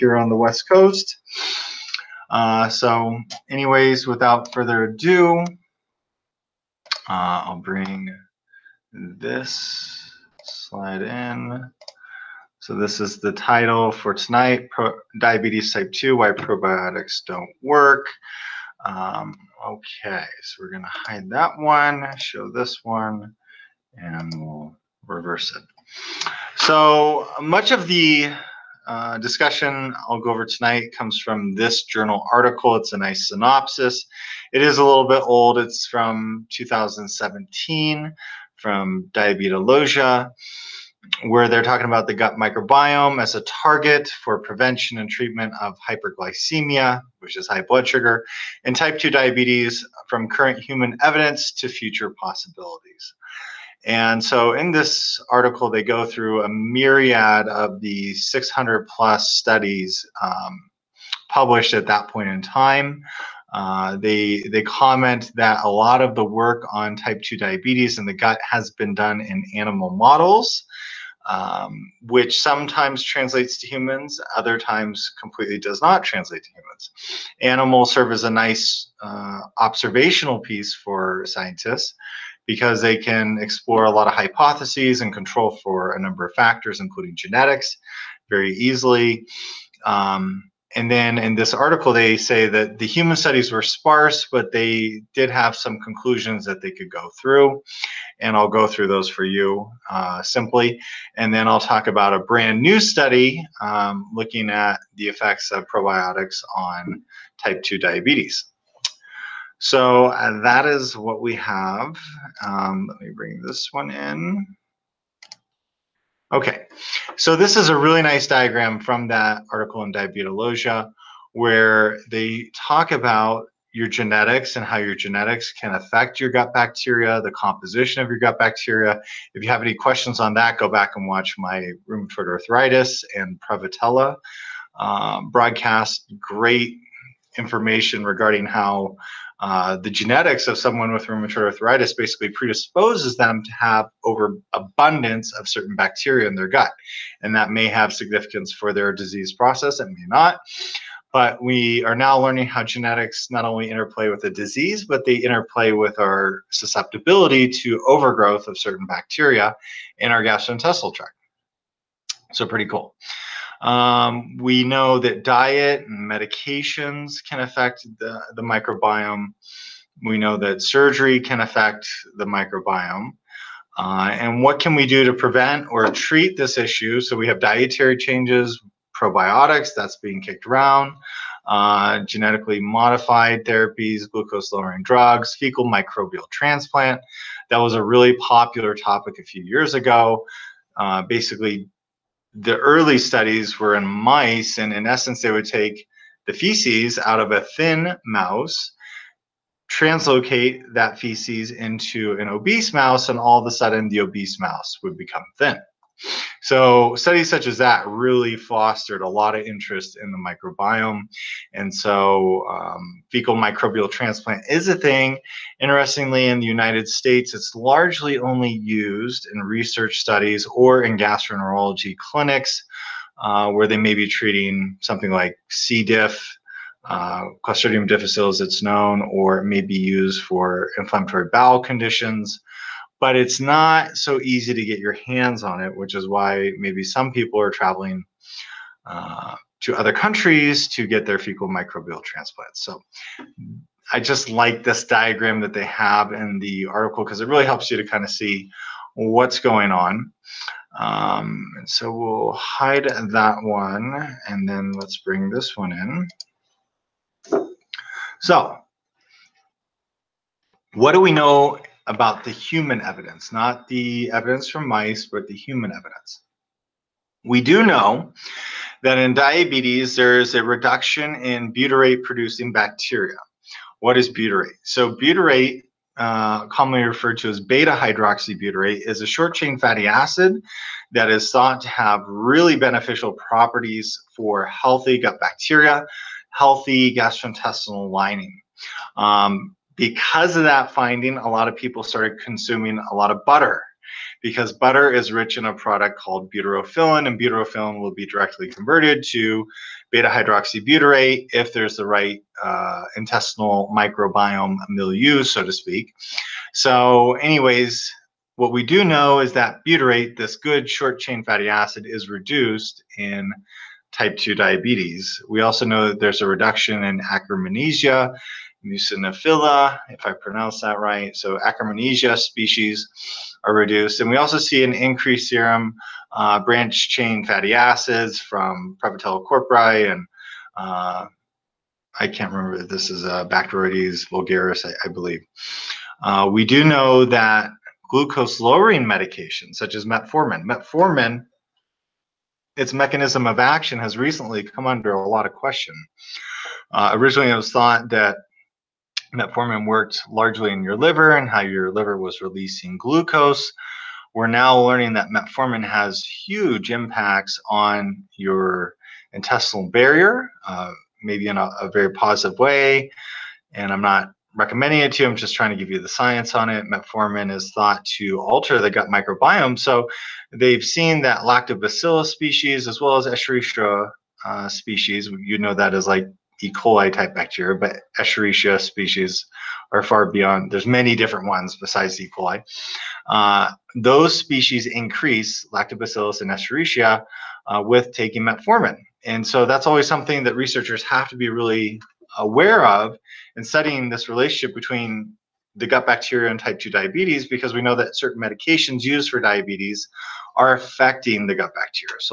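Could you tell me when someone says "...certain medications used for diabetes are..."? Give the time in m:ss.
6:37.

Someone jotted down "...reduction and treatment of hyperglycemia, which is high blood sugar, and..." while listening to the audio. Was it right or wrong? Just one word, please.
wrong.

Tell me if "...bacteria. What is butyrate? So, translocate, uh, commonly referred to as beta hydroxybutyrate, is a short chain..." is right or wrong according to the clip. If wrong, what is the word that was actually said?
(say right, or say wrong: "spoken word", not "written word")
wrong: "butyrate", not "translocate".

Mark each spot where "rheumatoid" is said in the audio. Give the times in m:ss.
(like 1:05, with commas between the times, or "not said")
2:11, 2:21.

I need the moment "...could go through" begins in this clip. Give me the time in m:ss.
1:36.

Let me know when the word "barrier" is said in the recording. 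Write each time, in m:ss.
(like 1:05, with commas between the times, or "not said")
5:59.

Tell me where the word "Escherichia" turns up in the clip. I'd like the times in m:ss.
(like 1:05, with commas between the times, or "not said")
6:13, 6:17, 6:26.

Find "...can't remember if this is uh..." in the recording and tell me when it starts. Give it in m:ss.
5:32.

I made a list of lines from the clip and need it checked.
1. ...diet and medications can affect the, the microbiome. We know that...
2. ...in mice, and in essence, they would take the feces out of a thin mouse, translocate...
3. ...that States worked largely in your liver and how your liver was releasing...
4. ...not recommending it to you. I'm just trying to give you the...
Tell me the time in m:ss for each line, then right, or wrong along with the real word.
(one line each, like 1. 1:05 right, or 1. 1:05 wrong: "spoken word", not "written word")
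1. 2:45 right
2. 3:13 right
3. 5:47 wrong: "Metformin", not "States"
4. 6:03 right.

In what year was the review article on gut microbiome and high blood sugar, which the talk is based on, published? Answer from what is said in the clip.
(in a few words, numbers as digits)
2017.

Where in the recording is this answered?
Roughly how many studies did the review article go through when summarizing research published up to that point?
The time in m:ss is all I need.
0:58.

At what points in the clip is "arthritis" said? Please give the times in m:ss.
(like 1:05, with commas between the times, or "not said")
2:12, 2:21.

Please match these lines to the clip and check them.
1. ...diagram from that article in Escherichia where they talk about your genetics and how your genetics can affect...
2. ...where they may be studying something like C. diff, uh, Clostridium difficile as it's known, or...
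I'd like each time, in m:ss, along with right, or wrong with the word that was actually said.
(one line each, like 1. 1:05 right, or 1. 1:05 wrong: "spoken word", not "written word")
1. 1:58 wrong: "Diabetologia", not "Escherichia"
2. 3:43 wrong: "treating", not "studying".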